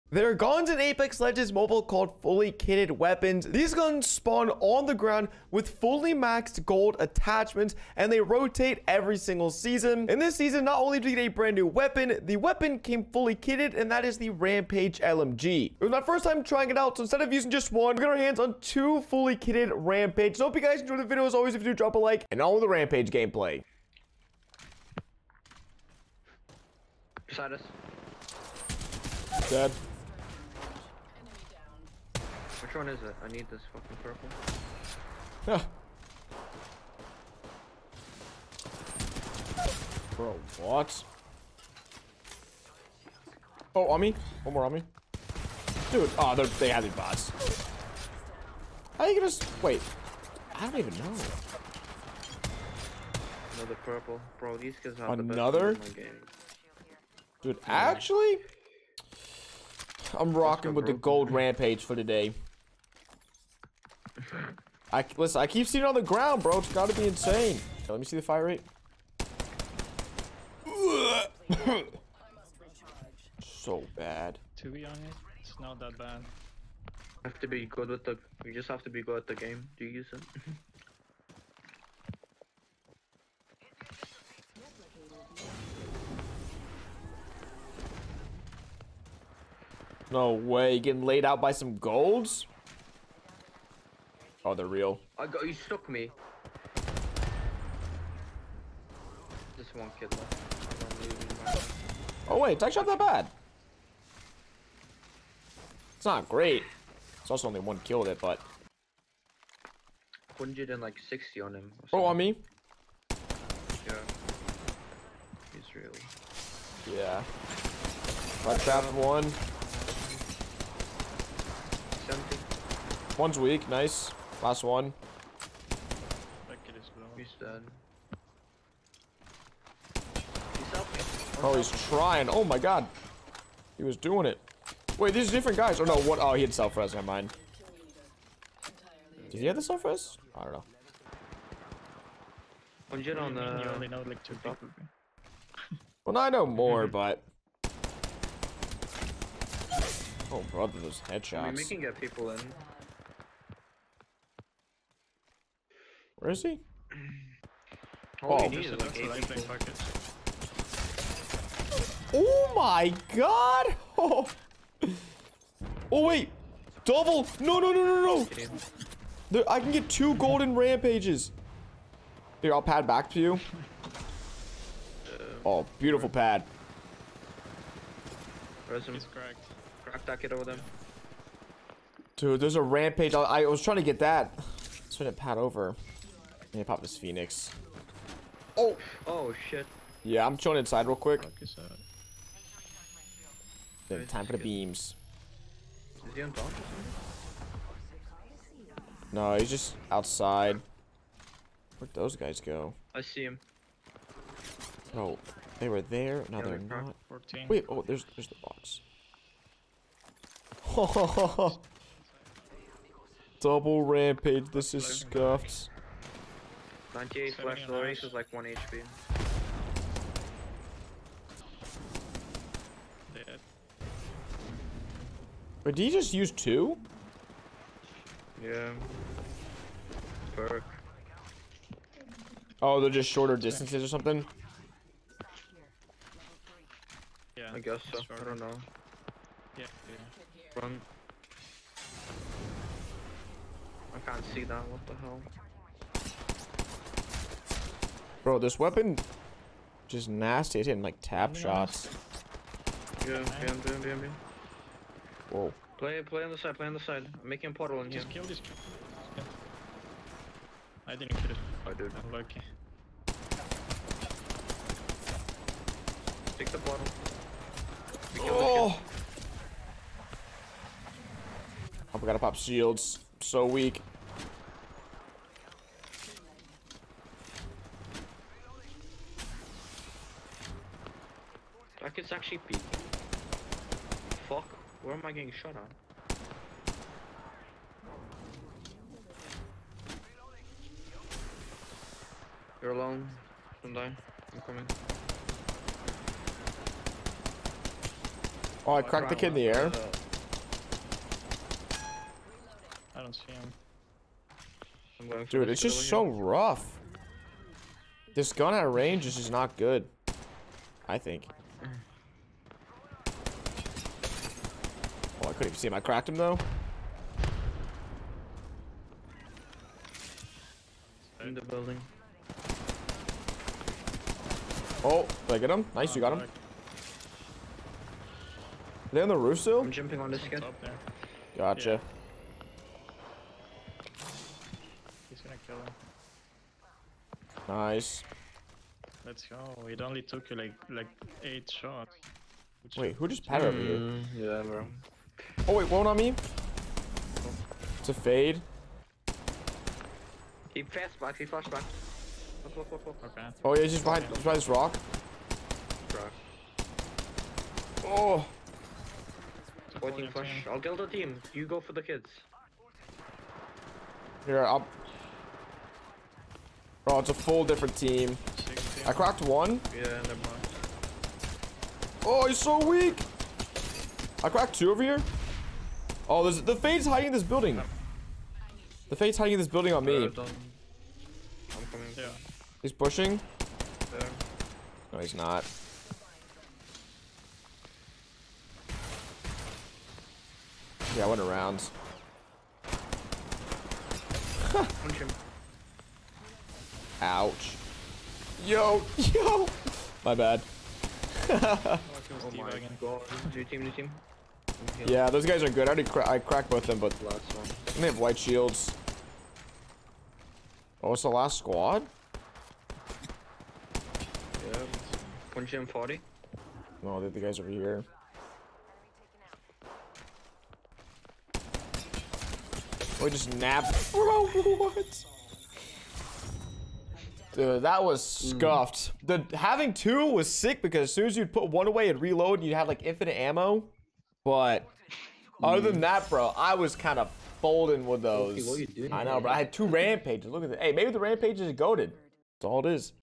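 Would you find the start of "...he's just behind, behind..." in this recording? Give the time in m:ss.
5:53.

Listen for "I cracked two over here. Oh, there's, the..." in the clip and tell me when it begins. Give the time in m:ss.
6:14.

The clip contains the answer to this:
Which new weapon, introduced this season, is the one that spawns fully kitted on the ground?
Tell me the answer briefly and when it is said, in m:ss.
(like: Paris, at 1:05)
Rampage LMG, at 0:14.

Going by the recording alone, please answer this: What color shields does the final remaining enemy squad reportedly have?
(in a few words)
White.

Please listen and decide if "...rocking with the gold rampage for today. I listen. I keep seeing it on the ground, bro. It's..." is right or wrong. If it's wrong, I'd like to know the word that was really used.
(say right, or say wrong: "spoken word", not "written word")
right.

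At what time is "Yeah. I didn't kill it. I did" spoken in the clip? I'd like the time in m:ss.
4:19.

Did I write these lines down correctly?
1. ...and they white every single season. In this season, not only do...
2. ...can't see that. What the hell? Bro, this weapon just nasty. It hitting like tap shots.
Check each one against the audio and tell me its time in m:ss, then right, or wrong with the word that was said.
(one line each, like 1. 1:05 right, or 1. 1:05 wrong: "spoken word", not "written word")
1. 0:07 wrong: "rotate", not "white"
2. 4:04 right.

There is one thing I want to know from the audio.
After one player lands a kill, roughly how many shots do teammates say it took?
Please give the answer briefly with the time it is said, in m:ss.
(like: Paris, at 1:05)
8, at 5:41.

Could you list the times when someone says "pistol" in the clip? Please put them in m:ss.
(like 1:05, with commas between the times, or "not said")
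not said.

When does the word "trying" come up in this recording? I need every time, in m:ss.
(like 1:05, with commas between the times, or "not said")
0:16, 2:11, 3:03.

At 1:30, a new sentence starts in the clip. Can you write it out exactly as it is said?
Getting laid out by some golds.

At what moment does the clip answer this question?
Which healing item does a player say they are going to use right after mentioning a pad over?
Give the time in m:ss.
3:06.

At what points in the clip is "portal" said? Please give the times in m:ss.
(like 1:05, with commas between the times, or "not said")
4:17, 4:26.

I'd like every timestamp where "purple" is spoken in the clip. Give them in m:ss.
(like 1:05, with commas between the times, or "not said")
0:34, 0:53.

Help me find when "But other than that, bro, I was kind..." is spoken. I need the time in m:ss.
7:14.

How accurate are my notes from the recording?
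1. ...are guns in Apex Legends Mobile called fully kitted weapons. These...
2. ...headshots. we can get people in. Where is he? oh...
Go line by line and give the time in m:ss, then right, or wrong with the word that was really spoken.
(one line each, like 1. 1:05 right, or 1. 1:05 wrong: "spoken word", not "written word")
1. 0:00 right
2. 2:31 right.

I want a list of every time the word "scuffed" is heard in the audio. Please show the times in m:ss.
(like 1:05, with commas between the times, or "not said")
3:34, 7:08.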